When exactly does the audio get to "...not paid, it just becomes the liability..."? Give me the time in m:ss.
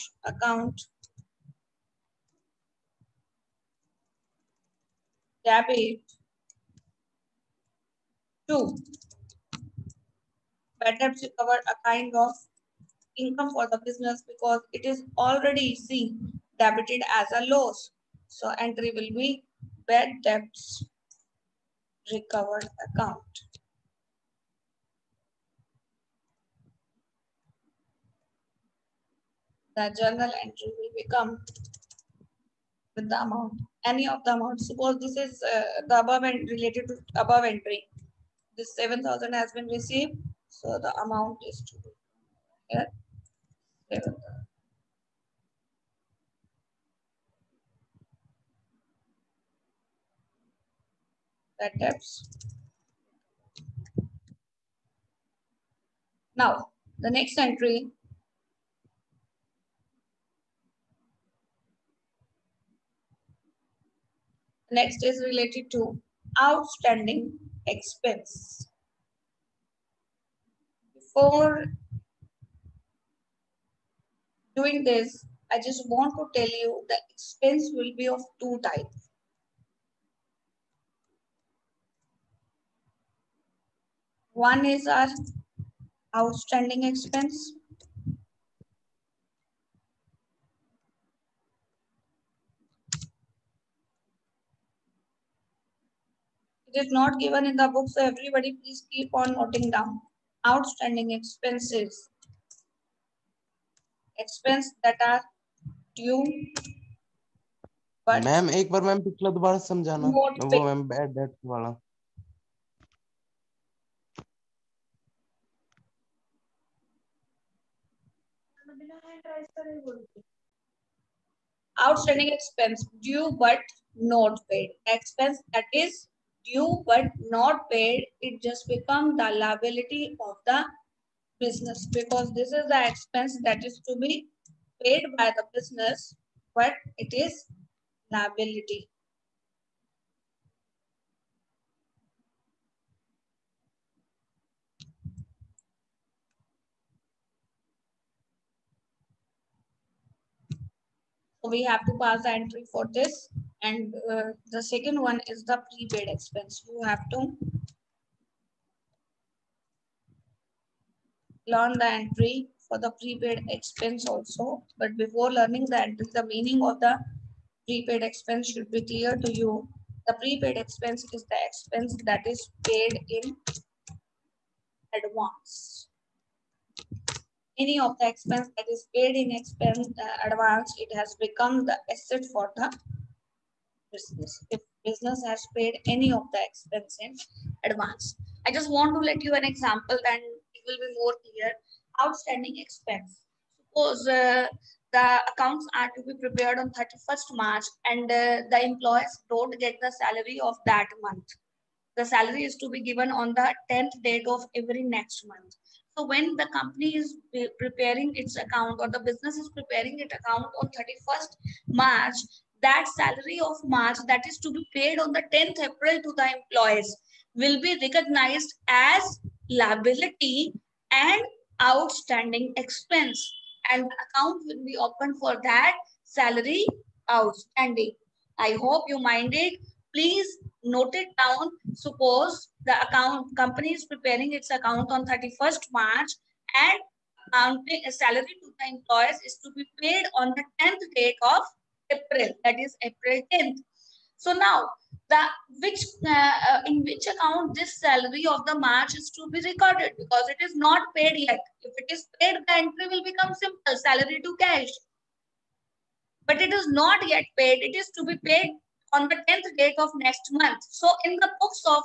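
2:07.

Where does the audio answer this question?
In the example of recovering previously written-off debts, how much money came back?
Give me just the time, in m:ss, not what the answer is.
0:38.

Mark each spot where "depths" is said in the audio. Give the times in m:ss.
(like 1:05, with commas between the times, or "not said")
0:51.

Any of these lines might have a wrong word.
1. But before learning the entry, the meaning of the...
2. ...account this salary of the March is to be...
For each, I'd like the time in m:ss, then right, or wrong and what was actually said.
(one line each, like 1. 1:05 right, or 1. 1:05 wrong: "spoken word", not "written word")
1. 2:44 right
2. 4:07 right.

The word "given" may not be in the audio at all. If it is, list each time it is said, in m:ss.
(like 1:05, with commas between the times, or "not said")
1:37, 3:22.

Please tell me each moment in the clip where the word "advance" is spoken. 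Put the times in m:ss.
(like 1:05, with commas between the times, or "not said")
2:54, 3:00, 3:07.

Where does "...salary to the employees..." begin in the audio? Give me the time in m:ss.
3:57.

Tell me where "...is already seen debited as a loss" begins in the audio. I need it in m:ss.
0:14.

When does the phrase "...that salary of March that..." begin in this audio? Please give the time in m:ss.
3:32.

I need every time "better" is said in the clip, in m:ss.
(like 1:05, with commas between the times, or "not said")
0:10.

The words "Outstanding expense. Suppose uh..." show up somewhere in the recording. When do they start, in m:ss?
3:12.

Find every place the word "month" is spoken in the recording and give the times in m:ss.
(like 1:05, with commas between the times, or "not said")
3:21, 3:25, 4:20.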